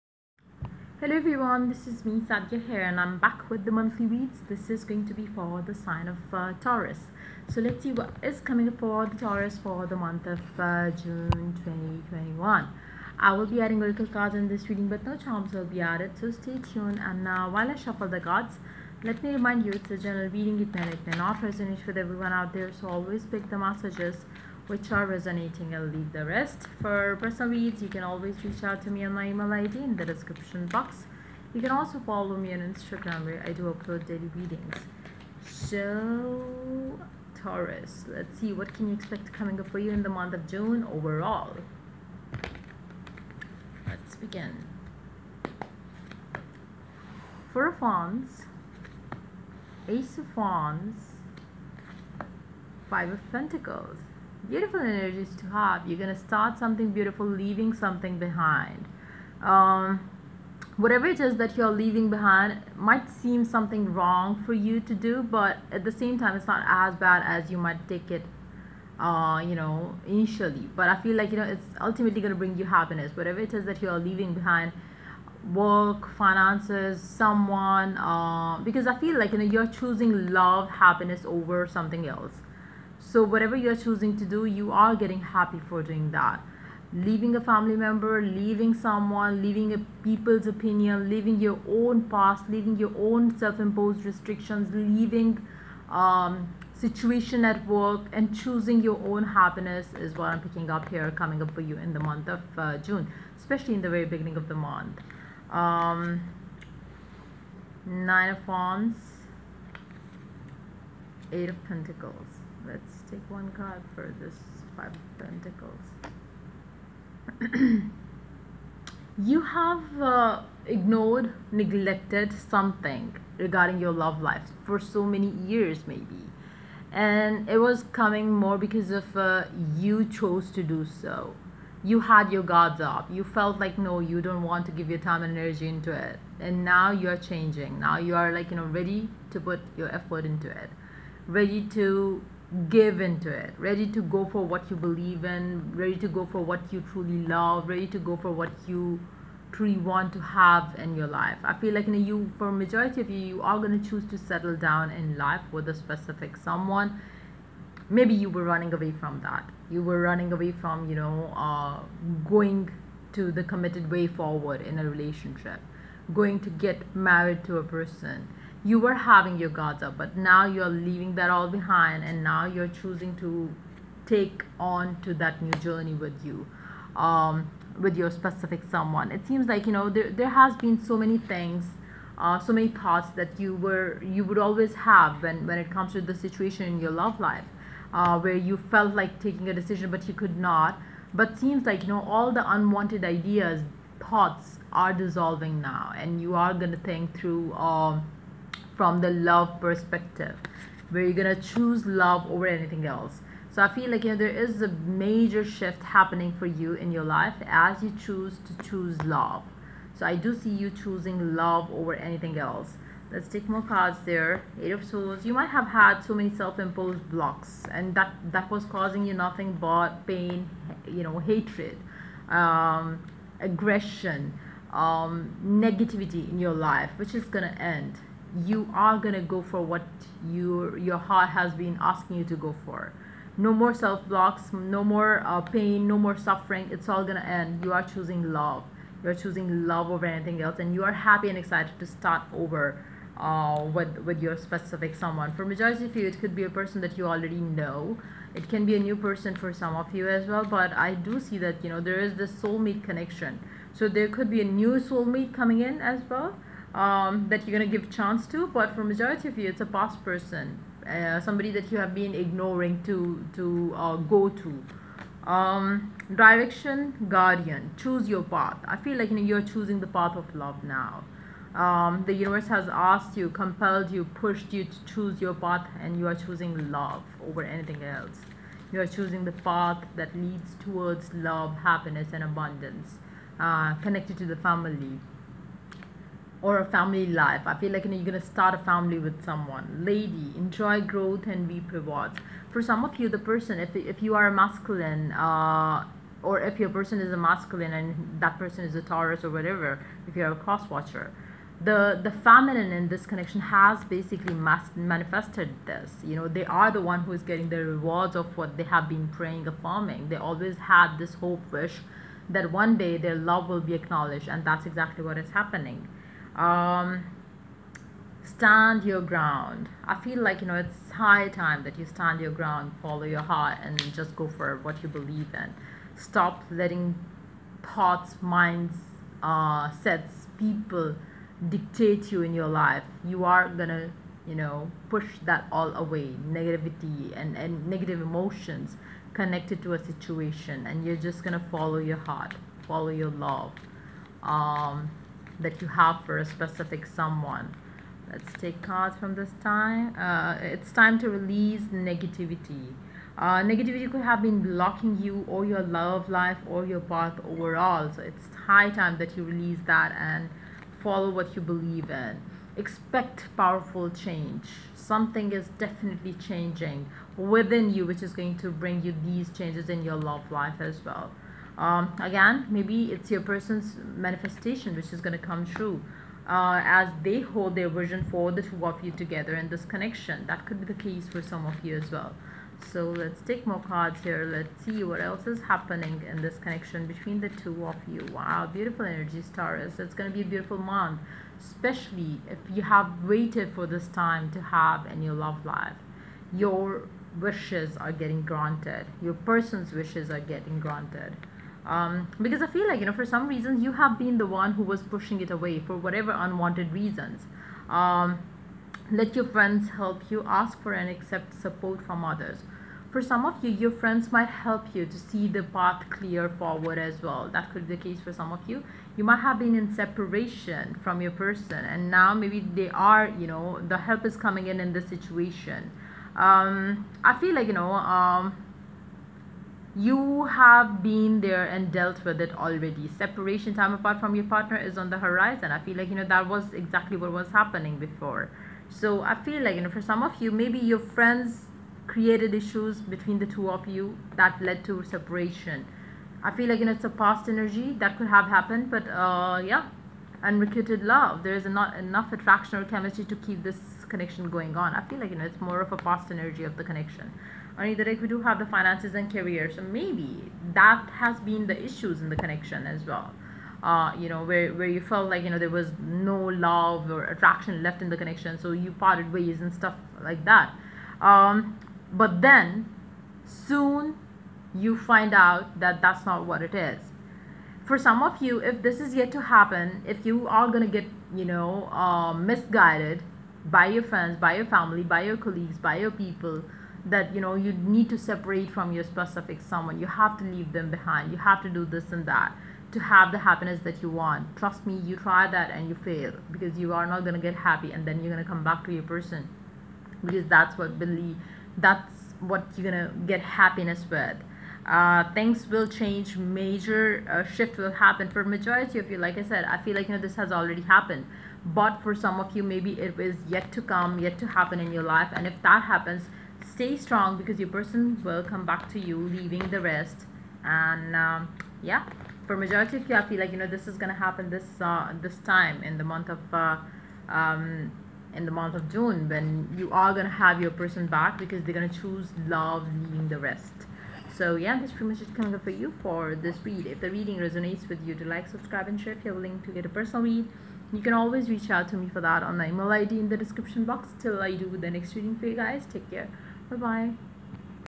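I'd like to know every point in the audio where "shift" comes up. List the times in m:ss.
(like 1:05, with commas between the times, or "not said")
3:25, 8:27.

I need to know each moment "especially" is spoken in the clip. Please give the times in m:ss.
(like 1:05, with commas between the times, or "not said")
1:43, 6:31.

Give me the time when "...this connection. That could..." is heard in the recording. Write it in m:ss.
6:19.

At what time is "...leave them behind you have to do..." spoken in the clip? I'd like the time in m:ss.
8:10.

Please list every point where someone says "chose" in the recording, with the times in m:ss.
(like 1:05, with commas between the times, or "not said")
2:10.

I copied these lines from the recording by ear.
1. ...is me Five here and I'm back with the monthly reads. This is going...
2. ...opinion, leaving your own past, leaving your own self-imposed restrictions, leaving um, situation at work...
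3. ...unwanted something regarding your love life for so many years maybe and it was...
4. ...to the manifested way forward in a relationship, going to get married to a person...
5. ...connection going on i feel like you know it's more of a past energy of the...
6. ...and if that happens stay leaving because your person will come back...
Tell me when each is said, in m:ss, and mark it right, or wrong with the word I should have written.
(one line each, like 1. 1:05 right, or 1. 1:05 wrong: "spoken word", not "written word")
1. 0:01 wrong: "Sadia", not "Five"
2. 1:30 right
3. 2:01 wrong: "neglected", not "unwanted"
4. 2:43 wrong: "committed", not "manifested"
5. 7:33 right
6. 8:35 wrong: "strong", not "leaving".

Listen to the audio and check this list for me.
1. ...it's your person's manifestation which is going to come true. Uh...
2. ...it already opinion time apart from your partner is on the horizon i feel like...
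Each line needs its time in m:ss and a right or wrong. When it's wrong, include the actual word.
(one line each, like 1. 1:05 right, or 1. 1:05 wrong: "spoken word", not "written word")
1. 6:12 right
2. 7:12 wrong: "separation", not "opinion".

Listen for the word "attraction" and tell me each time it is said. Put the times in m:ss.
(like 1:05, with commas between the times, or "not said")
7:32, 7:47.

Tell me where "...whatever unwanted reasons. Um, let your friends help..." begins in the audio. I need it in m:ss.
6:45.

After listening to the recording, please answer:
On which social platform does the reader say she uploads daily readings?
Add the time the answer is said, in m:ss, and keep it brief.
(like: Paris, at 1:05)
Instagram, at 0:32.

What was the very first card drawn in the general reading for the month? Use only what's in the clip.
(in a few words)
Four of Wands.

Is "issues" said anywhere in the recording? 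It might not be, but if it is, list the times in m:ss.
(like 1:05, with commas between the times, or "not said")
7:22, 7:41.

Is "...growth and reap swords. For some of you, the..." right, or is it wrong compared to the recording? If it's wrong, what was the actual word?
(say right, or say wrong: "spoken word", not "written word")
wrong: "rewards", not "swords".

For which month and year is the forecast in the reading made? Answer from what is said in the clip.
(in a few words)
June 2021.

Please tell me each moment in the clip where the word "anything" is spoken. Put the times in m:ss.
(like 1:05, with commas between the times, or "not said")
3:22, 3:31, 4:00, 4:37.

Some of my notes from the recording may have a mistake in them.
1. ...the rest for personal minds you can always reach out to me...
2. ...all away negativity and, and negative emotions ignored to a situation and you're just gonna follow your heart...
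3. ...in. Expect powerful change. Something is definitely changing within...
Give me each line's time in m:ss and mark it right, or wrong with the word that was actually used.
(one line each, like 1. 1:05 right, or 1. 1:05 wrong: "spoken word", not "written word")
1. 0:26 wrong: "reads", not "minds"
2. 5:35 wrong: "connected", not "ignored"
3. 6:01 right.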